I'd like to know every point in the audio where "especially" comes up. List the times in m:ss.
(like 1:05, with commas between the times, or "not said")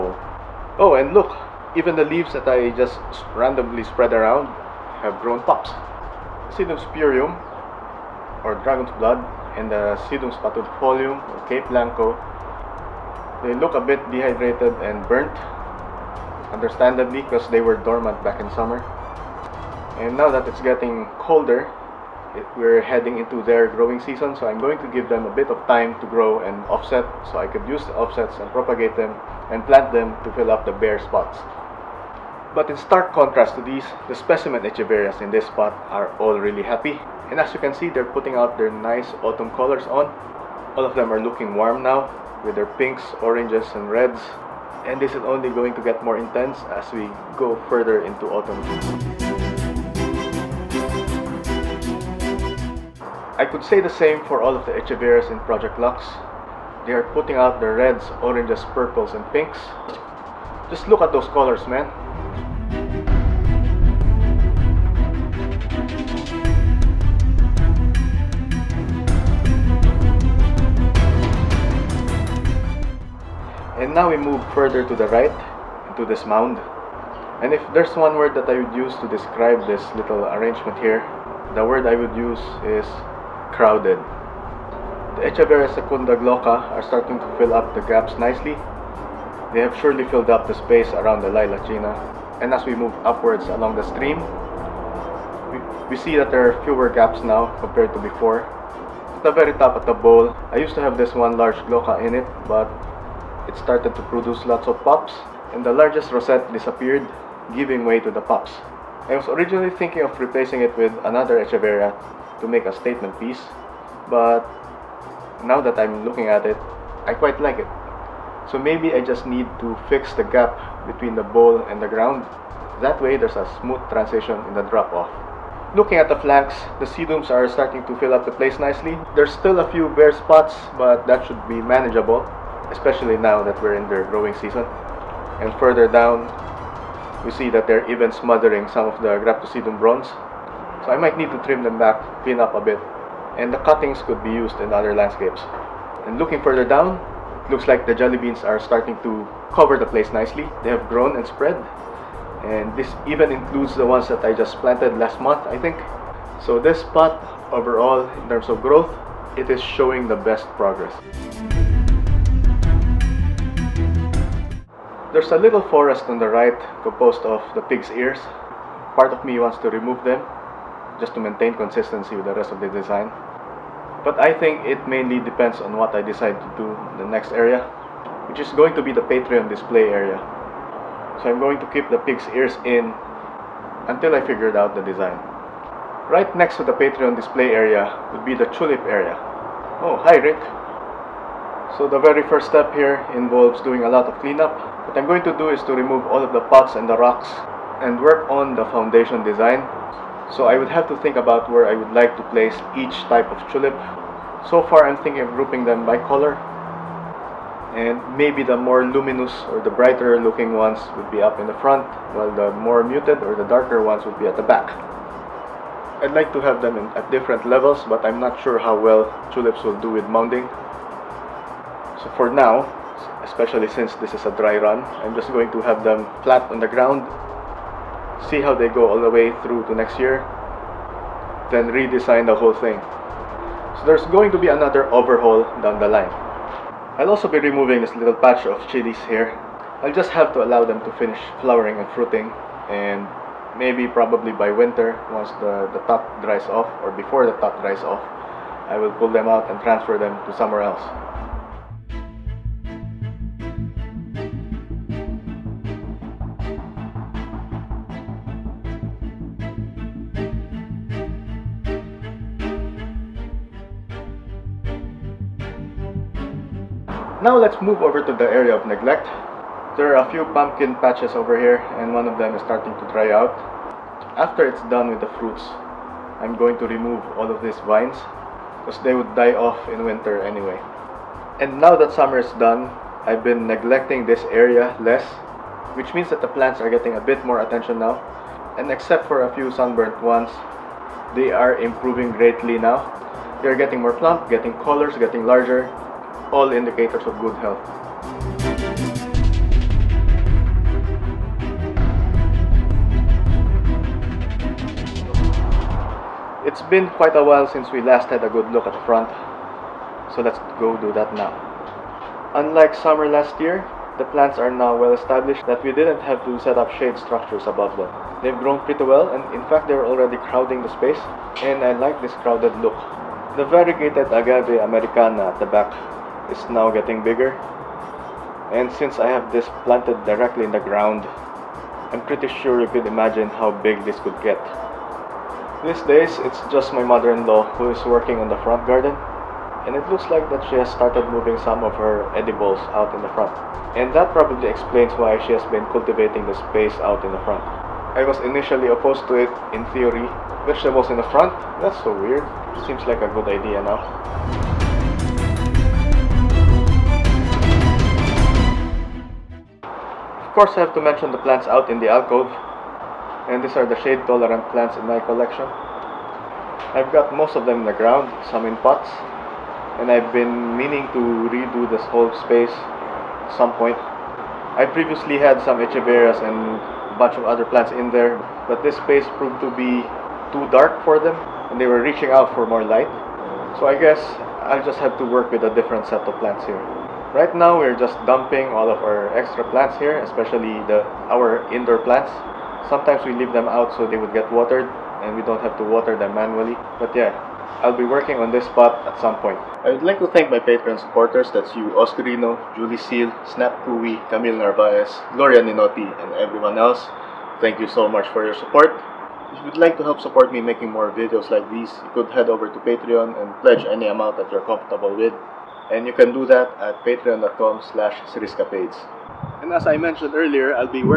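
2:12, 3:43, 6:29.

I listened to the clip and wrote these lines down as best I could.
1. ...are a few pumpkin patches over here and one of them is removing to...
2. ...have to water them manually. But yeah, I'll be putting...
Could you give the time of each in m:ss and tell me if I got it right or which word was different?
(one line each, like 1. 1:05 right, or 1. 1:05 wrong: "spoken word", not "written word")
1. 4:29 wrong: "starting", not "removing"
2. 6:35 wrong: "working", not "putting".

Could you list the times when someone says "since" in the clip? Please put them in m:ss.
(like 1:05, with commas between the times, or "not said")
3:43, 5:07, 5:28.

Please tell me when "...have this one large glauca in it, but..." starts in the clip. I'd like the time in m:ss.
1:40.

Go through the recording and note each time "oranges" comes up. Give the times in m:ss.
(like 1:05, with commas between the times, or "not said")
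0:43, 0:58.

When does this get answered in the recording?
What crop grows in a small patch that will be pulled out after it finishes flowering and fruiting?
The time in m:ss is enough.
3:58.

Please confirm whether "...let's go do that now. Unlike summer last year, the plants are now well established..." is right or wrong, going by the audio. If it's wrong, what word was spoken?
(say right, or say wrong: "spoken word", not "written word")
right.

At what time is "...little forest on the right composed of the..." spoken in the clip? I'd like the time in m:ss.
2:45.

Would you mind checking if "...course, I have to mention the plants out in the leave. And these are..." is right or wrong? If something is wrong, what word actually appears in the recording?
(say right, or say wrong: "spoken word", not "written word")
wrong: "alcove", not "leave".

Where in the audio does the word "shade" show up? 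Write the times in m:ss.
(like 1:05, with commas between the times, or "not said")
5:16, 6:03.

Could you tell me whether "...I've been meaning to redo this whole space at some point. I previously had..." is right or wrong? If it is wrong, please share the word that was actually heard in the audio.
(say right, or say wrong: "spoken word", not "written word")
right.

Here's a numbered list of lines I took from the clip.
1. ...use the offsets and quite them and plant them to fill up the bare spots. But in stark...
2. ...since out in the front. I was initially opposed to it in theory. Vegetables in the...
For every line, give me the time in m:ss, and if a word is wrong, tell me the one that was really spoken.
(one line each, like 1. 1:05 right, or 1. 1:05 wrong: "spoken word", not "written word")
1. 0:27 wrong: "propagate", not "quite"
2. 5:46 wrong: "space", not "since".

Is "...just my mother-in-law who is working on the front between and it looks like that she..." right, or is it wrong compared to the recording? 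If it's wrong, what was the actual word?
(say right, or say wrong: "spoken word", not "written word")
wrong: "garden", not "between".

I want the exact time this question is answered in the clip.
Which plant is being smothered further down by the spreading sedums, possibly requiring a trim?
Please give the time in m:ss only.
2:19.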